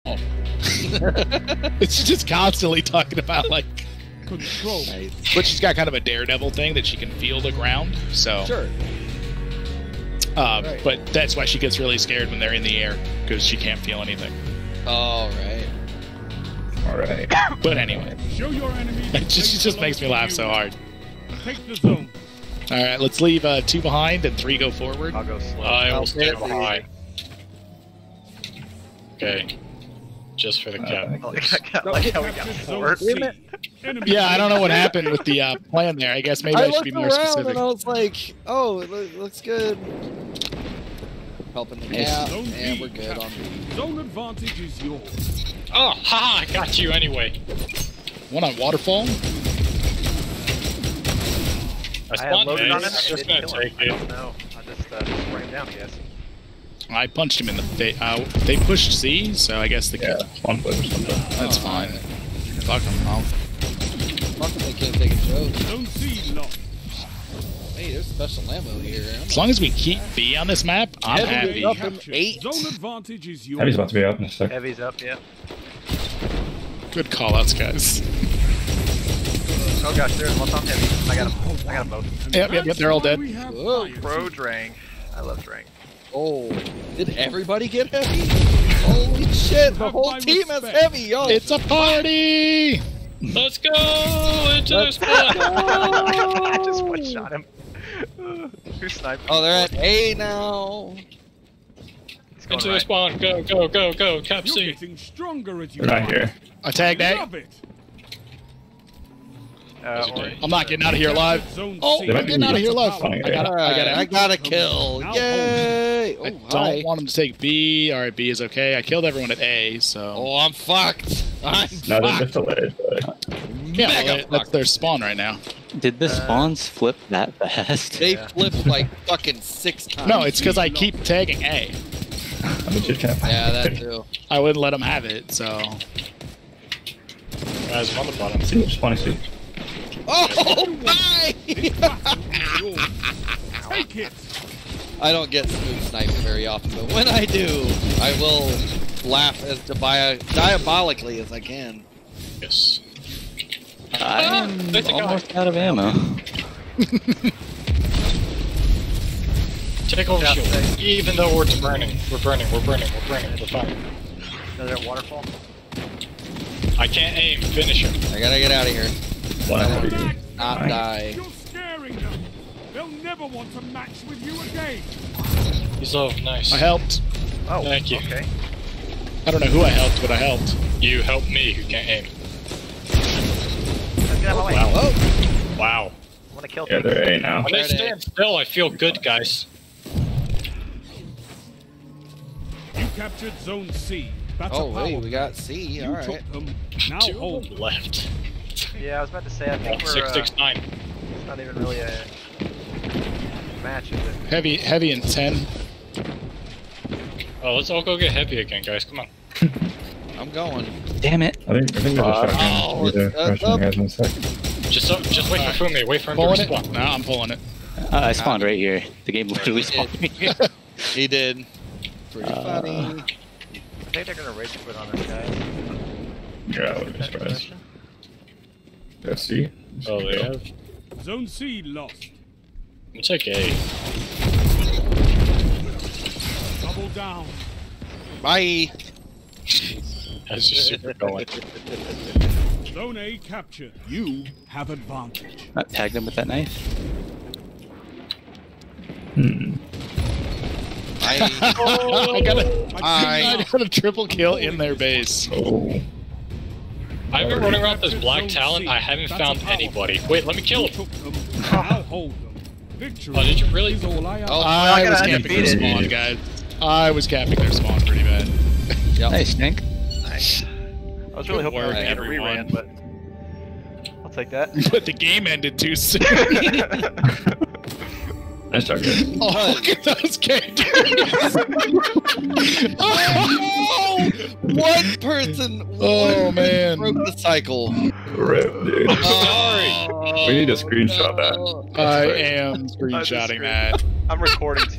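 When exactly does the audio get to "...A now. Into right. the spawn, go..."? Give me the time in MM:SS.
01:39.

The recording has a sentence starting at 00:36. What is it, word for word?
I guess maybe I, I should be more specific.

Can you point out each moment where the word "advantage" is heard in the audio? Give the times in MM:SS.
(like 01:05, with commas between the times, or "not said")
00:43, 01:12, 04:04.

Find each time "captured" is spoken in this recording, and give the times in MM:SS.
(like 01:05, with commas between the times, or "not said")
03:12, 04:03.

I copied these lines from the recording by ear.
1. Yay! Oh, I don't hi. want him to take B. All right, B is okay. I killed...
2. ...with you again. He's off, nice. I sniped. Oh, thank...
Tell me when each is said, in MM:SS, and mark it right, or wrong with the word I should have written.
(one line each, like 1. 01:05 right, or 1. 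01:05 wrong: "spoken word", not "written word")
1. 01:55 right
2. 02:54 wrong: "helped", not "sniped".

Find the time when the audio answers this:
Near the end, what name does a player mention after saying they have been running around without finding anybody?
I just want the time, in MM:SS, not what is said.
04:17.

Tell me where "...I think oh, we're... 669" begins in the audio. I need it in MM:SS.
03:19.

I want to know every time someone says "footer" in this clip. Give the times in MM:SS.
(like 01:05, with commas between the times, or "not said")
not said.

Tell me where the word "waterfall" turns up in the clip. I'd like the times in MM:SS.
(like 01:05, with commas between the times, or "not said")
00:48, 02:44.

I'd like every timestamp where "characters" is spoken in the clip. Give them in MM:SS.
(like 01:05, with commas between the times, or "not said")
04:40.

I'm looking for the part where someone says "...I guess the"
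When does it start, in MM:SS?
00:59.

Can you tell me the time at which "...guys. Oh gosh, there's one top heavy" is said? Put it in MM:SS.
01:17.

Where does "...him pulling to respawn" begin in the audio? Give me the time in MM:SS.
03:36.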